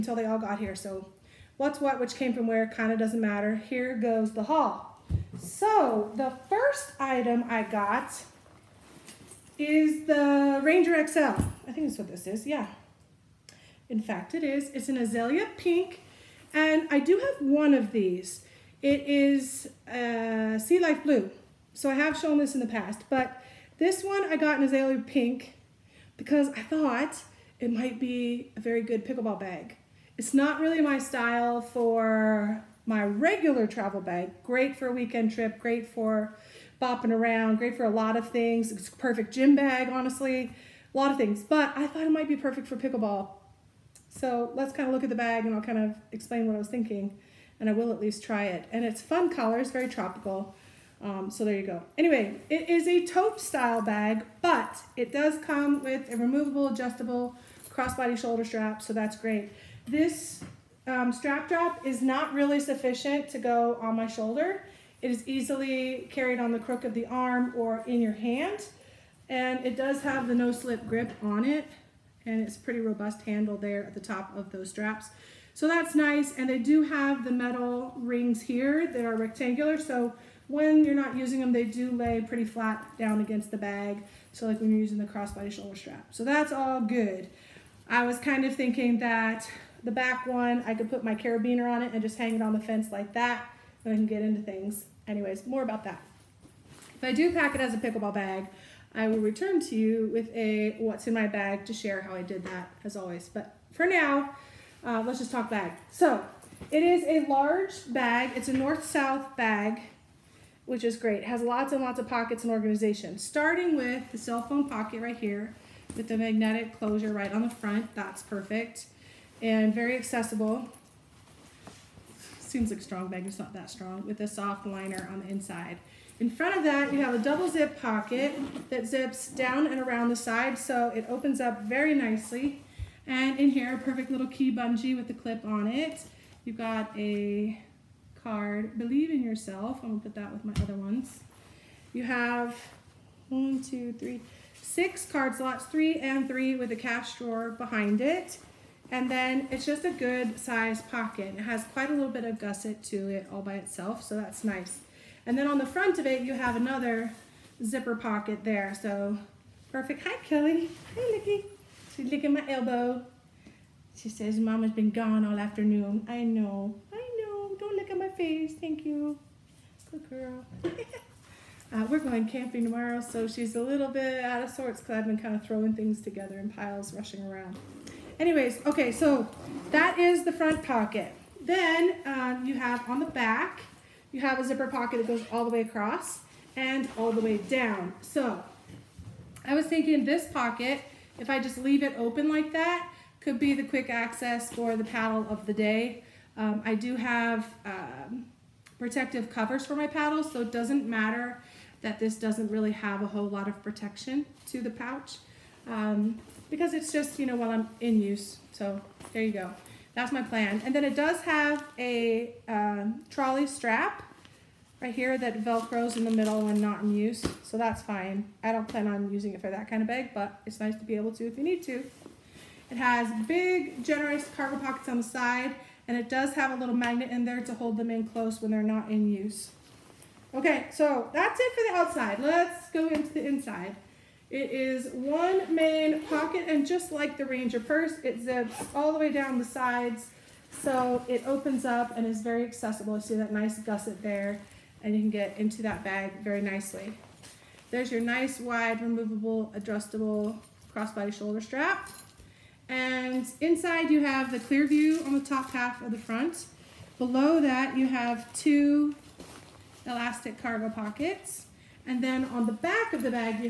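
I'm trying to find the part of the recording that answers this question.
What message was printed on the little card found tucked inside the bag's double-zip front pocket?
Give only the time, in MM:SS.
02:18.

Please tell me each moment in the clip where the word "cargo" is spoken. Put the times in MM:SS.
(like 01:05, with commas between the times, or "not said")
03:44, 04:20.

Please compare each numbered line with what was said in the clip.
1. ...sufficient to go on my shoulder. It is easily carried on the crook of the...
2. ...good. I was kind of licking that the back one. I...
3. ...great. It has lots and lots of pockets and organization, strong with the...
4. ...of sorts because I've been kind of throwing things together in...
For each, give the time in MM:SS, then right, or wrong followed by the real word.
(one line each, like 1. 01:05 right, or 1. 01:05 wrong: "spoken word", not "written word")
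1. 01:02 right
2. 01:26 wrong: "thinking", not "licking"
3. 01:50 wrong: "starting", not "strong"
4. 02:54 right.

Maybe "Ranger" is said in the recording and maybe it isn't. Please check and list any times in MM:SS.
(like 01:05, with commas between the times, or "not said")
00:10, 03:57.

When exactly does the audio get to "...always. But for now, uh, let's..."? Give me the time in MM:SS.
01:42.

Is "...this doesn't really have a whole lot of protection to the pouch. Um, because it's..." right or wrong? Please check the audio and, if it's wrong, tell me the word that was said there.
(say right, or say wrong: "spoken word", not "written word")
right.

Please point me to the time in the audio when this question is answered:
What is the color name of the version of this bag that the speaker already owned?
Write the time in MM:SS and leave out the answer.
00:20.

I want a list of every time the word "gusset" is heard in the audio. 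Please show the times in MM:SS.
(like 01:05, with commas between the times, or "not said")
02:32, 04:03.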